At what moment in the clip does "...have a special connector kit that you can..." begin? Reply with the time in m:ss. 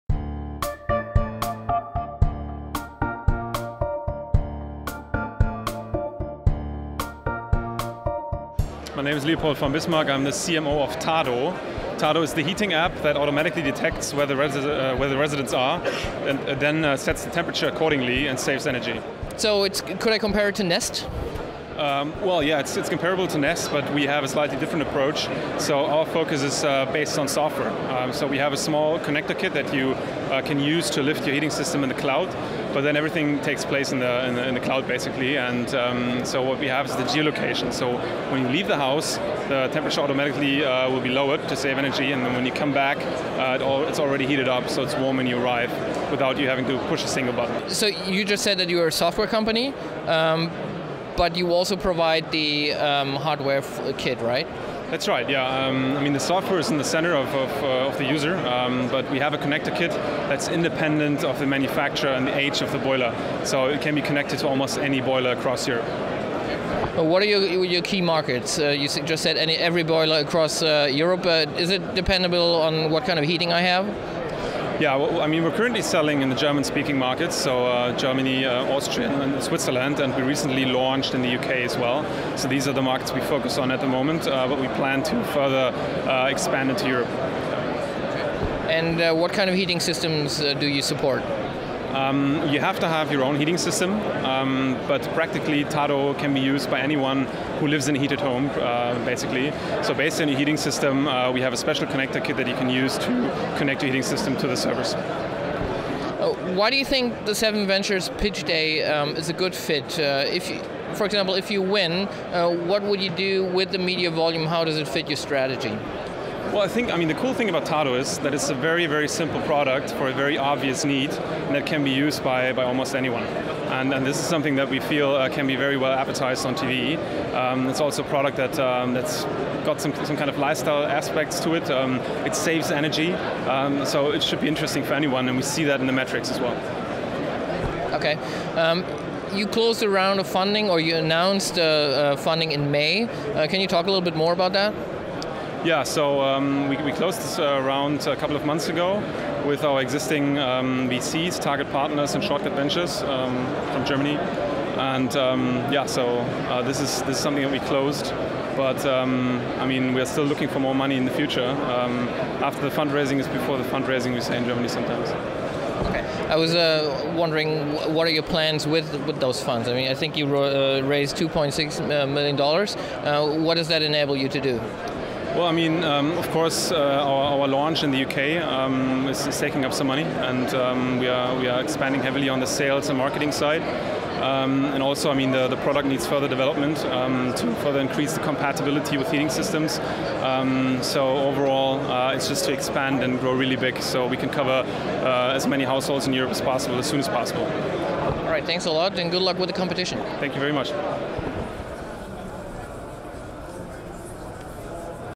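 1:41.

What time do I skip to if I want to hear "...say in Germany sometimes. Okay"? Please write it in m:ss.
2:44.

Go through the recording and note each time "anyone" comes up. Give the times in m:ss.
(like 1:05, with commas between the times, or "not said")
1:36, 2:02, 2:14.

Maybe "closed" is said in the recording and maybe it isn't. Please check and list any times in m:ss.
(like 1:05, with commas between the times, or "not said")
2:19, 2:26, 2:37.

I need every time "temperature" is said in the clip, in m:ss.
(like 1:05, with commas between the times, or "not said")
0:17, 0:39.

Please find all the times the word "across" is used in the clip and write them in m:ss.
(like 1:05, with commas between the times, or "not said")
1:05, 1:10.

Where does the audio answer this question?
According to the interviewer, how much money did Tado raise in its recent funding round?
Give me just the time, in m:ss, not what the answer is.
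2:51.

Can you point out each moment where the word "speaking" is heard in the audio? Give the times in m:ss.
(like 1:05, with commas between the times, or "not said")
1:16.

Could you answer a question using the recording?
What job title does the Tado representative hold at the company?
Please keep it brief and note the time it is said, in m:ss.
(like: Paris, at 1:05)
CMO, at 0:10.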